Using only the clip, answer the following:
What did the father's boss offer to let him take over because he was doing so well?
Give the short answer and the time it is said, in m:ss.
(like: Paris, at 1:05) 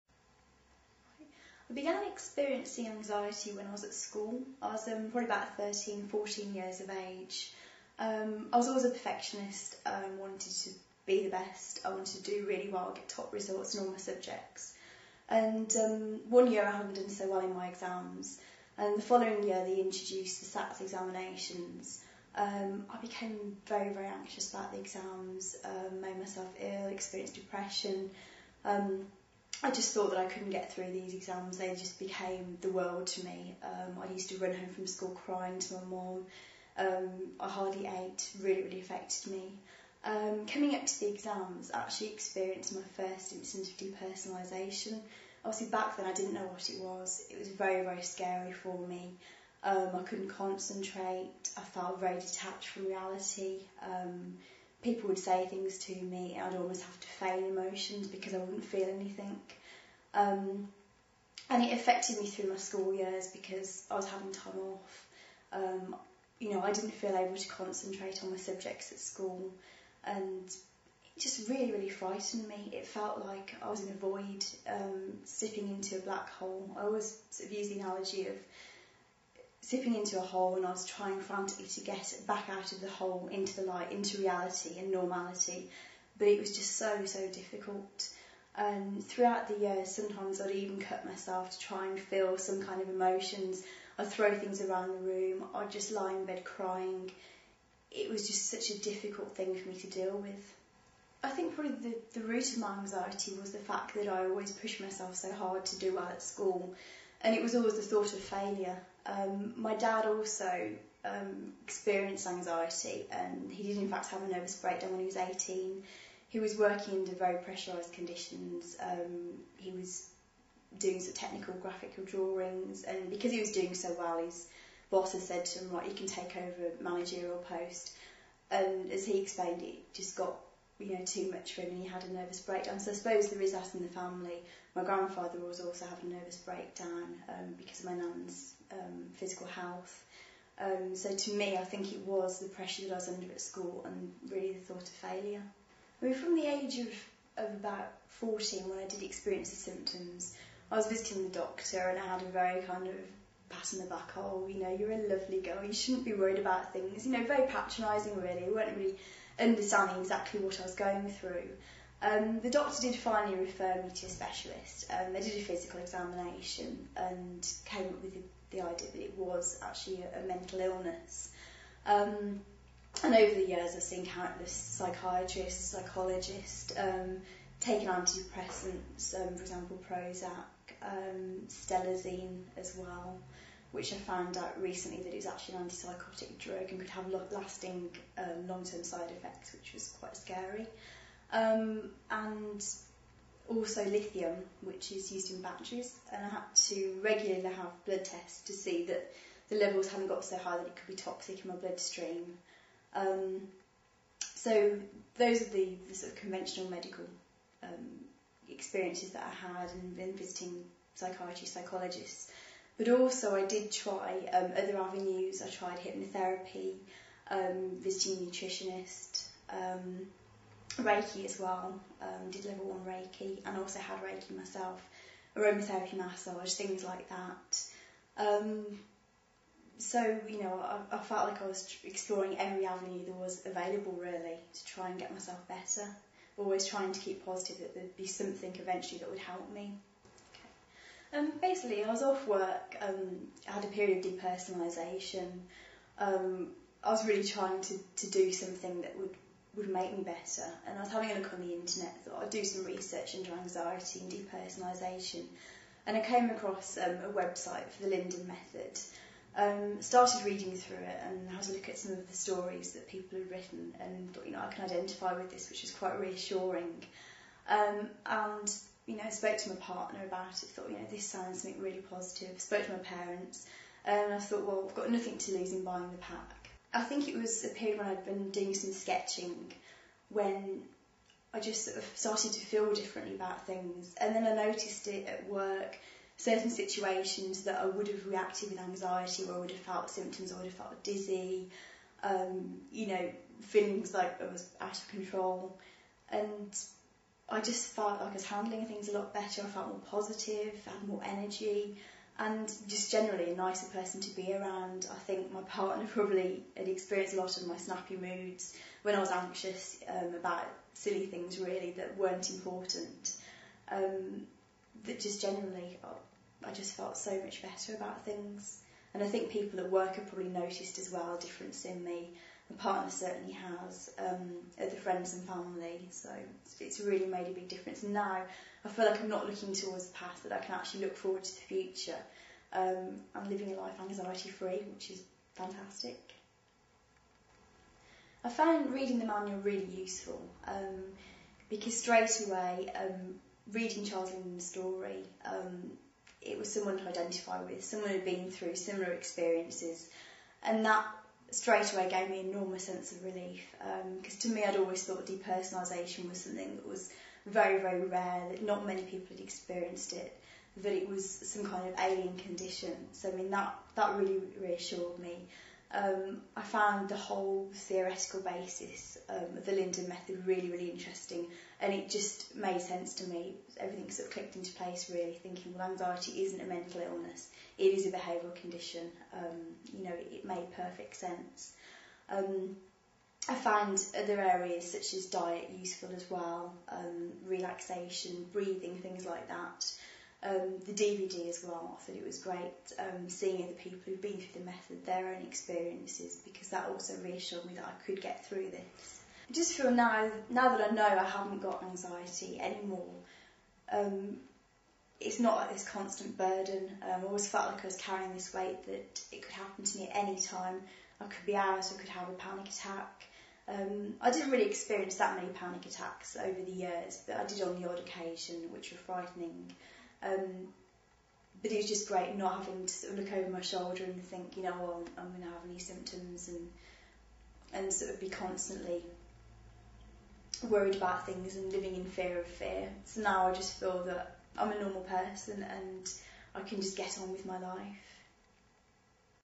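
a managerial post, at 2:06.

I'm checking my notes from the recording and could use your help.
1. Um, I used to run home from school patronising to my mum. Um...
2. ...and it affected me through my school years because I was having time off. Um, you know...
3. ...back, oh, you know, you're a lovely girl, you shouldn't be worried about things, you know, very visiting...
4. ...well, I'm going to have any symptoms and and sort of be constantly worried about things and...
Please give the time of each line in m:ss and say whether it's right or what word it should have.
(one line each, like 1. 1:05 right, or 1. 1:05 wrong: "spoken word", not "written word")
1. 0:33 wrong: "crying", not "patronising"
2. 1:01 right
3. 2:33 wrong: "patronising", not "visiting"
4. 7:04 right.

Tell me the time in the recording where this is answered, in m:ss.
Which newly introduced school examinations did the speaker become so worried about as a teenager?
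0:20.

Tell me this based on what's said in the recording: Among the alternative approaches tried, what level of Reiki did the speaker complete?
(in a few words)
level one.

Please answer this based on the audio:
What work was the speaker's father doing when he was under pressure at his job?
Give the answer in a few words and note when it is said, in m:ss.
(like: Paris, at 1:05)
technical graphical drawings, at 2:01.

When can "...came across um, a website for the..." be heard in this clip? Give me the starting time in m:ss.
4:15.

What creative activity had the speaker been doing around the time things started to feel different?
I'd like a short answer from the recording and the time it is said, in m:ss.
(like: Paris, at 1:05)
sketching, at 4:38.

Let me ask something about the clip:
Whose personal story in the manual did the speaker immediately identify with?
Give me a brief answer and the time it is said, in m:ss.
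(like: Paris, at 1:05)
Charles Linden, at 5:43.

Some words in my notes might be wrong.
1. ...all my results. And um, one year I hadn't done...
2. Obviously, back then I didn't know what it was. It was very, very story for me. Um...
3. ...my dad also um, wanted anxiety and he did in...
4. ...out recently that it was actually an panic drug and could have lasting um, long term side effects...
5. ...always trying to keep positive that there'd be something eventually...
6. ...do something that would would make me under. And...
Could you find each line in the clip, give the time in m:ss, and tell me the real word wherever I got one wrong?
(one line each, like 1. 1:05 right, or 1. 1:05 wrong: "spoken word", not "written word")
1. 0:13 wrong: "subjects", not "results"
2. 0:45 wrong: "scary", not "story"
3. 1:49 wrong: "experienced", not "wanted"
4. 3:04 wrong: "antipsychotic", not "panic"
5. 3:56 right
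6. 4:08 wrong: "better", not "under".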